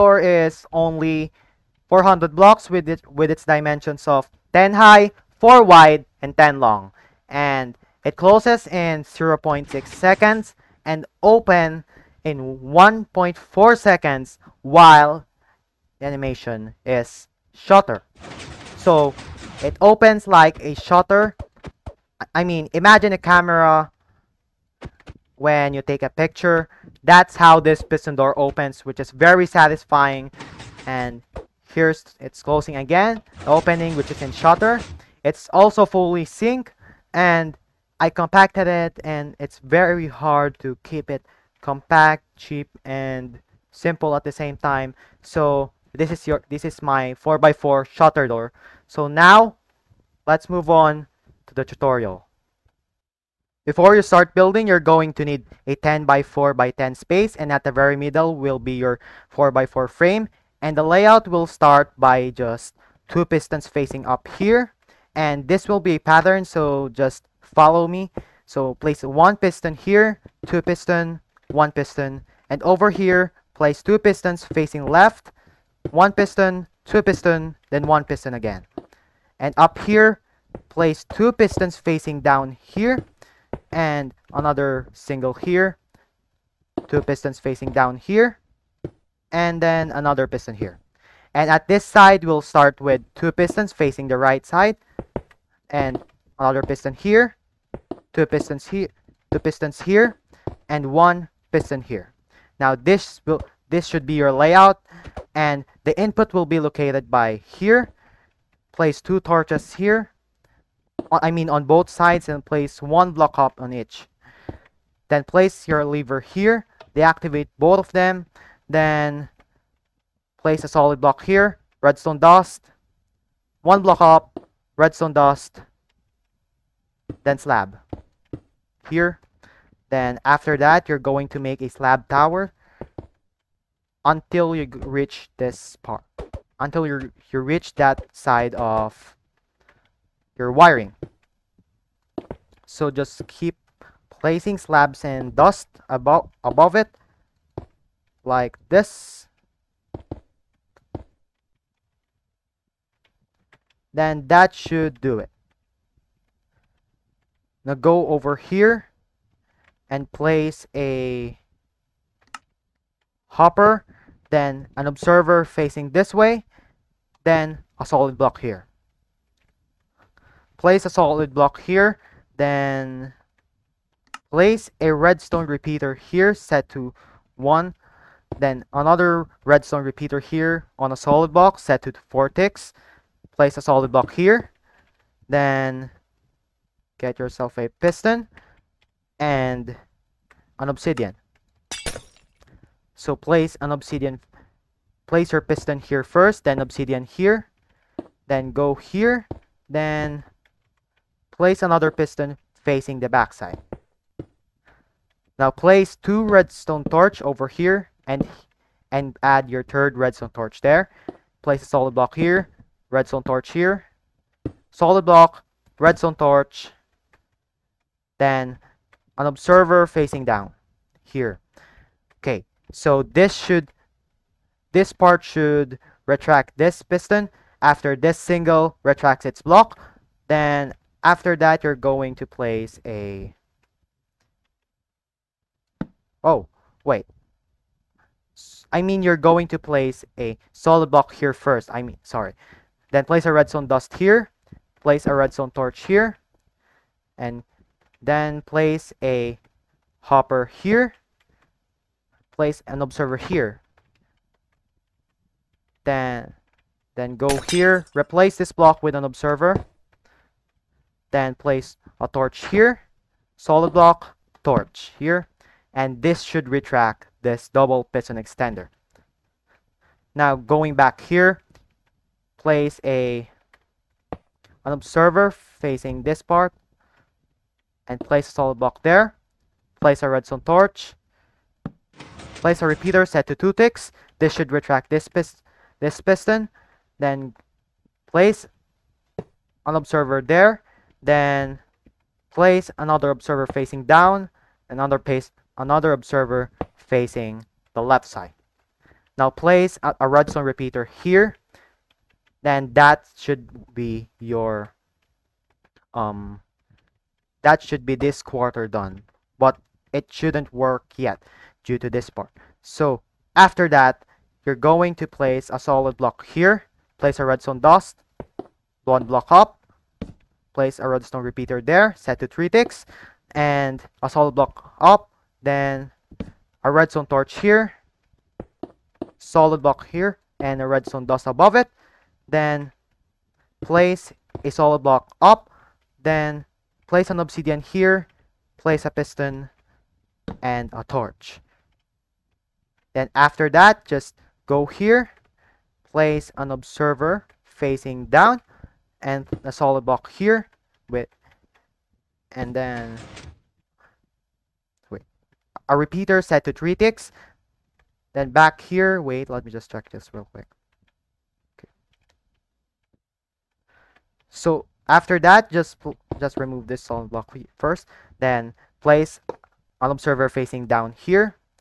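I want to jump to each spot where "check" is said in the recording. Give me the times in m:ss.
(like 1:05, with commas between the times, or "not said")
5:59.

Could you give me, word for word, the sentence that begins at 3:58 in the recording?
I mean you're going to place a solid block here first.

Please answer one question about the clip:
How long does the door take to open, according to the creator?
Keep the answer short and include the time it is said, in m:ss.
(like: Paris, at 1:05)
1.4 seconds, at 0:12.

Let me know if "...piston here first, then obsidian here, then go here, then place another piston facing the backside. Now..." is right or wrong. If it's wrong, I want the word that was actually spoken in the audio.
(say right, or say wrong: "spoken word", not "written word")
right.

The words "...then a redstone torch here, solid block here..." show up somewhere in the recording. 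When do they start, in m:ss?
5:25.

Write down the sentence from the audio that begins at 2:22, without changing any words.
So just keep placing slabs and dust above above it like this.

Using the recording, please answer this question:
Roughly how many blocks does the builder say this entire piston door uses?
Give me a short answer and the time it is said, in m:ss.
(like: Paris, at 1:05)
400, at 0:01.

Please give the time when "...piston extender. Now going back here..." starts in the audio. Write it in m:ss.
4:27.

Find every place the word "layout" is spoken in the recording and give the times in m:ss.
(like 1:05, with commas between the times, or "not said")
1:00, 1:44.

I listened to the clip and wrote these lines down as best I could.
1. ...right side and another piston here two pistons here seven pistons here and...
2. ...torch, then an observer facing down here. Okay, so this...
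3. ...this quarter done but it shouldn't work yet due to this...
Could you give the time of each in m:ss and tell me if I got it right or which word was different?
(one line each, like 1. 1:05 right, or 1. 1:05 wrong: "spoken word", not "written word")
1. 1:34 wrong: "two", not "seven"
2. 3:36 right
3. 5:07 right.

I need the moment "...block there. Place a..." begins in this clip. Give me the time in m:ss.
4:38.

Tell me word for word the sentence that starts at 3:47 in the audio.
After this single retracts its block, then after that you're going to place a...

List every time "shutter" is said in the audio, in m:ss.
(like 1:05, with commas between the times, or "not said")
0:20, 0:34, 0:47.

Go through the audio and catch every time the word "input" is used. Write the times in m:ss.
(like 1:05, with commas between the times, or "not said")
1:45.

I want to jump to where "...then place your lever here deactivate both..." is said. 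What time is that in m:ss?
1:55.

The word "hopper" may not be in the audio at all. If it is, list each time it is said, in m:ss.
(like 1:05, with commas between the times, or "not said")
2:43, 4:10.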